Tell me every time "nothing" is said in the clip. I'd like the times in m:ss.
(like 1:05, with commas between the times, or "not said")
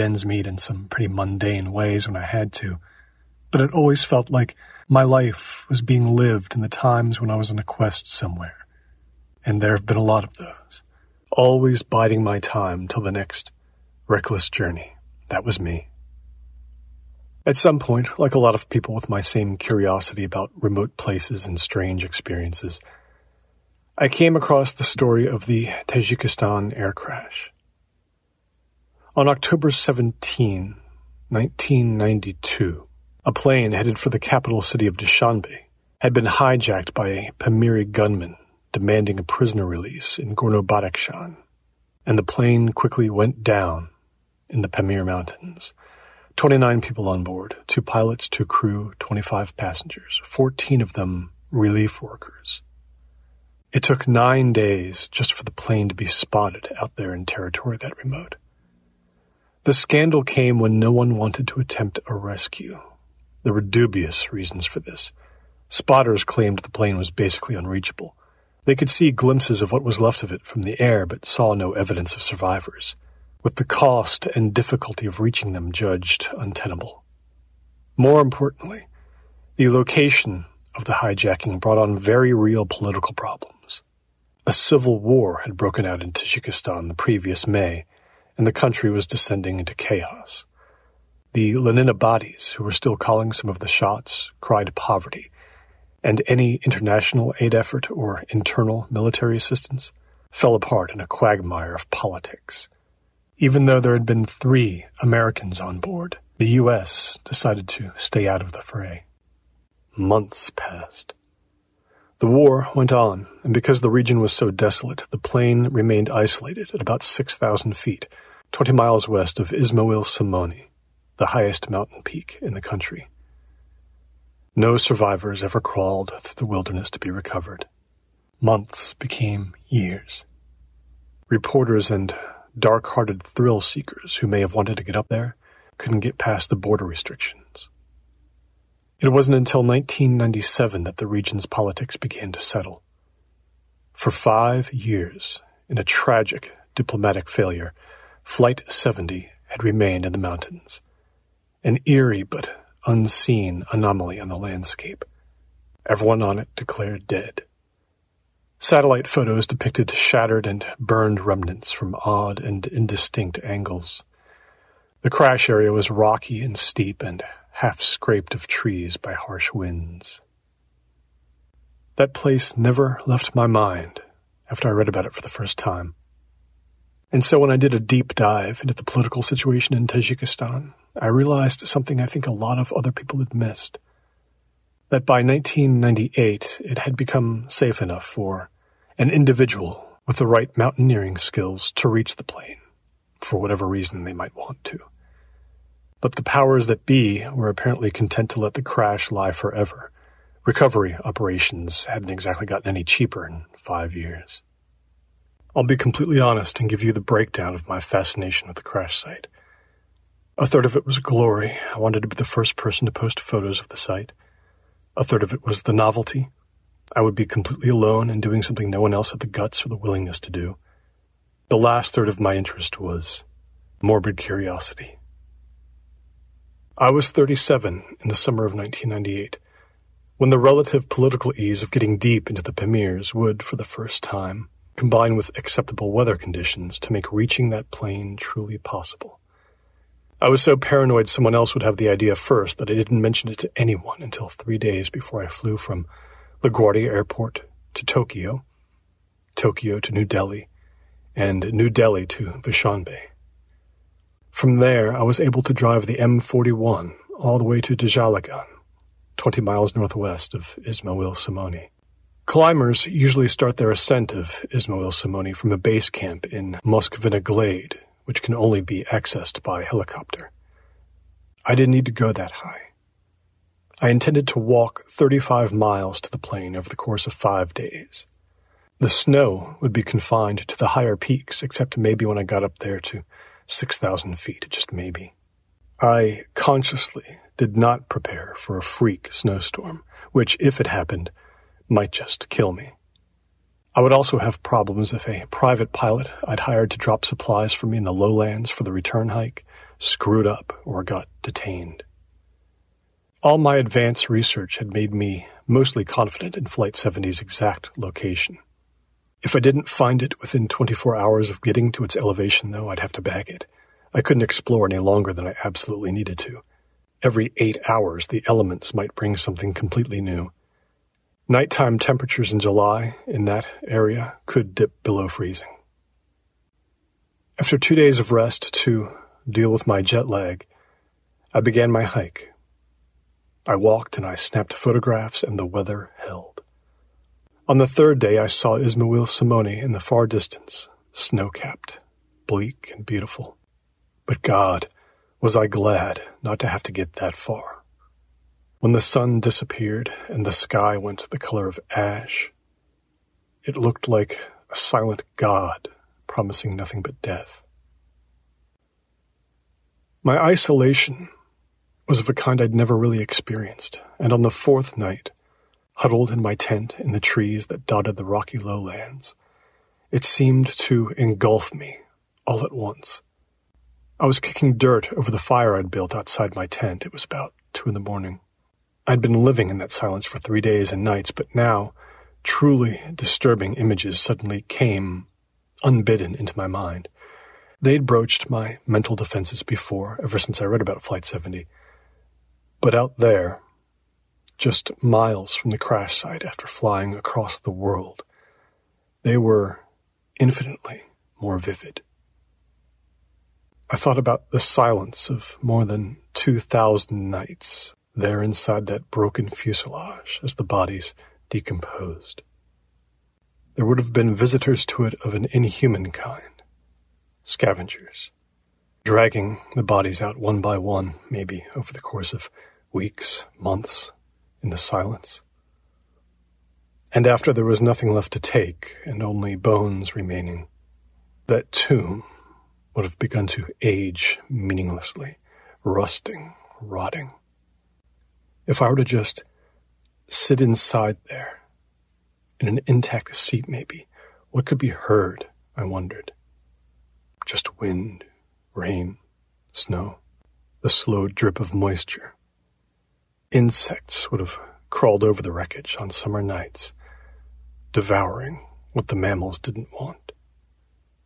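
5:56, 7:07.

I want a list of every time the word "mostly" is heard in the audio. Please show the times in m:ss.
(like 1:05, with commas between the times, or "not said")
5:05.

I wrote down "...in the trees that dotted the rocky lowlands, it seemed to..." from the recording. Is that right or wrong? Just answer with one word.
right.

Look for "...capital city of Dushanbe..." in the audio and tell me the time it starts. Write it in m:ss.
0:34.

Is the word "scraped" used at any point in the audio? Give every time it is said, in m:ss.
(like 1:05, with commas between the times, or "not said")
2:47.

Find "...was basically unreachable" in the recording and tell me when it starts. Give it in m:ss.
1:06.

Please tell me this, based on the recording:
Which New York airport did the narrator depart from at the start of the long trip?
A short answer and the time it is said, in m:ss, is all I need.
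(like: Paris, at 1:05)
LaGuardia Airport, at 4:06.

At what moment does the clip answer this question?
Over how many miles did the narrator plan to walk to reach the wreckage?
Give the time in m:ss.
4:34.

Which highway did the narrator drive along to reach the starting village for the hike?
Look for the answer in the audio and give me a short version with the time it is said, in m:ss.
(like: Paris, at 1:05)
M41, at 4:15.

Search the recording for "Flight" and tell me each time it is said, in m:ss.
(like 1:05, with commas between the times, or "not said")
2:28, 5:06, 6:30.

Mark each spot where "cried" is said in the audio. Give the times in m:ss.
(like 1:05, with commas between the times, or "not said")
1:34.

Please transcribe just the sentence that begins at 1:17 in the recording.
More importantly, the location of the hijacking brought on very real political problems.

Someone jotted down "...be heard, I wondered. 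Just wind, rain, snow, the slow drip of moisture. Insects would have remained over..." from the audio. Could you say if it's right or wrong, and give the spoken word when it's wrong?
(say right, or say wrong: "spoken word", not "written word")
wrong: "crawled", not "remained".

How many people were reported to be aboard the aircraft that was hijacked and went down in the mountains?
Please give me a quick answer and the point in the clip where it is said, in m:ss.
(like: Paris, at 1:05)
29, at 0:46.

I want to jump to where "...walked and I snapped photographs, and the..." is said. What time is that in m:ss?
5:33.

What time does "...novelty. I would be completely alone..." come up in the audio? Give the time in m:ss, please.
3:35.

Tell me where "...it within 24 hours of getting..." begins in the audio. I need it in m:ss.
5:10.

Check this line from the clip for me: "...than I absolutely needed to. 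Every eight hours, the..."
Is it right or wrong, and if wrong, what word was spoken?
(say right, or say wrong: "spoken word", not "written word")
right.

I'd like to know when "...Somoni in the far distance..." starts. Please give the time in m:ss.
5:39.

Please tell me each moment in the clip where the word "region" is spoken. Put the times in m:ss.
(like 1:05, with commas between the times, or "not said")
1:53, 2:21.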